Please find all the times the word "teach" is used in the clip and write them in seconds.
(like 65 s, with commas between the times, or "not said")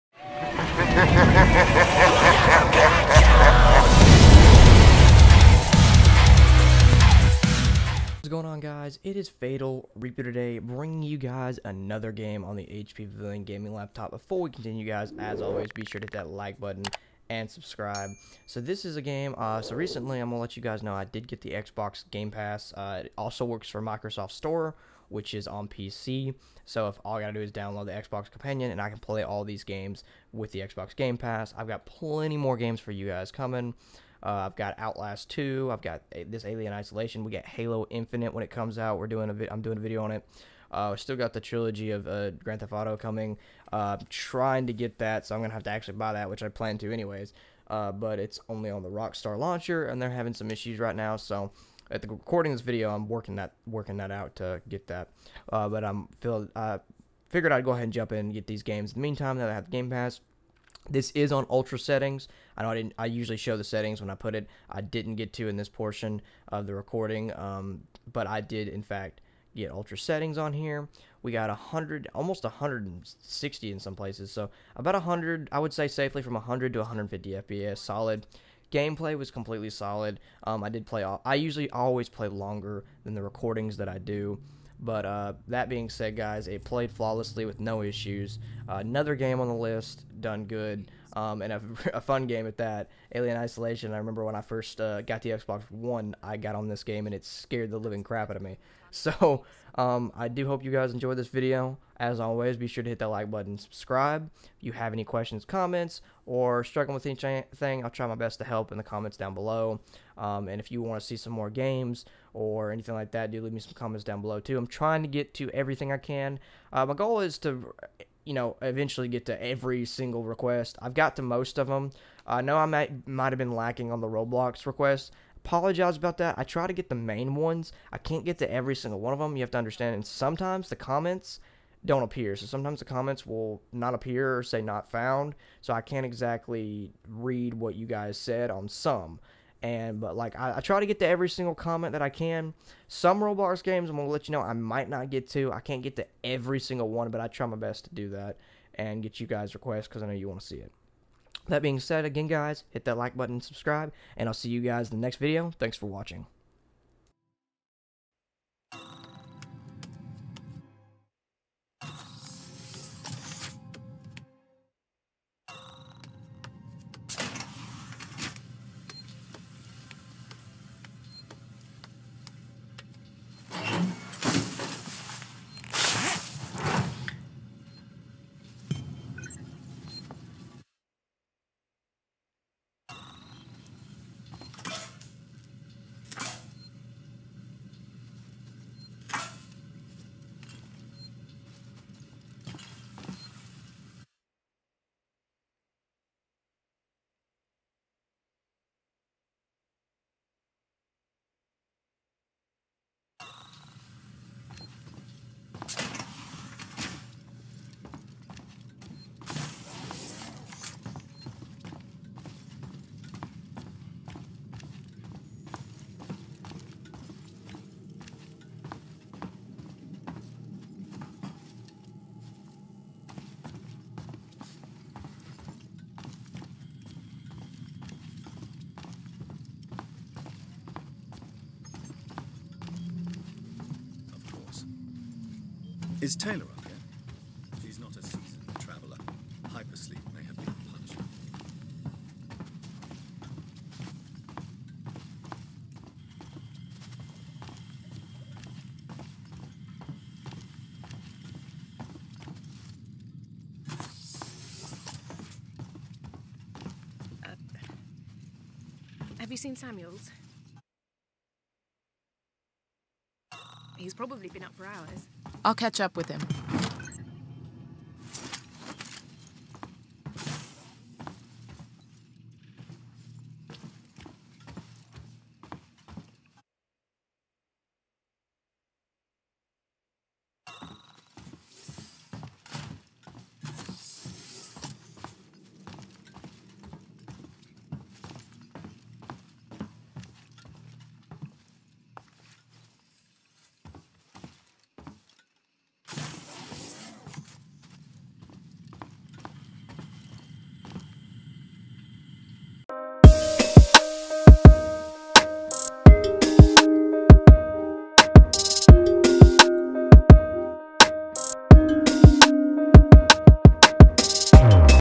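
not said.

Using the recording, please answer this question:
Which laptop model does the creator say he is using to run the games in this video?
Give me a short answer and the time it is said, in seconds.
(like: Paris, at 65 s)
HP Pavilion Gaming Laptop, at 12 s.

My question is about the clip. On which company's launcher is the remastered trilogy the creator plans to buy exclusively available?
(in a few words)
Rockstar.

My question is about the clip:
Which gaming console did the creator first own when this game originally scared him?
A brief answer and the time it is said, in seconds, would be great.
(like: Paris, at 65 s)
Xbox One, at 95 s.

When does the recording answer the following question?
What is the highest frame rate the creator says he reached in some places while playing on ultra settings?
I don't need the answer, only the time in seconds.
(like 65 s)
72 s.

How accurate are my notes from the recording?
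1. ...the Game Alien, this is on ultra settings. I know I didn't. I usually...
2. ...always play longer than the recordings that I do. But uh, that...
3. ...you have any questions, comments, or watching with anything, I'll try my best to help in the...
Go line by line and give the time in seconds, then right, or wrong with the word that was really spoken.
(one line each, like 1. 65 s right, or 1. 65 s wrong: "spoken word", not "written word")
1. 59 s wrong: "Pass", not "Alien"
2. 81 s right
3. 104 s wrong: "struggling", not "watching".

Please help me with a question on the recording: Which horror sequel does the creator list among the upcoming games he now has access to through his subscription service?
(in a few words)
Outlast 2.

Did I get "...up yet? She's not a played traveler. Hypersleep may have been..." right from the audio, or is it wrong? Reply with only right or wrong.
wrong.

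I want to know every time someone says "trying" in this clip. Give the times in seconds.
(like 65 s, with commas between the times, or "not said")
44 s, 114 s.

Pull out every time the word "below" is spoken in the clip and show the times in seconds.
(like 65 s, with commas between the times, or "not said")
109 s, 114 s.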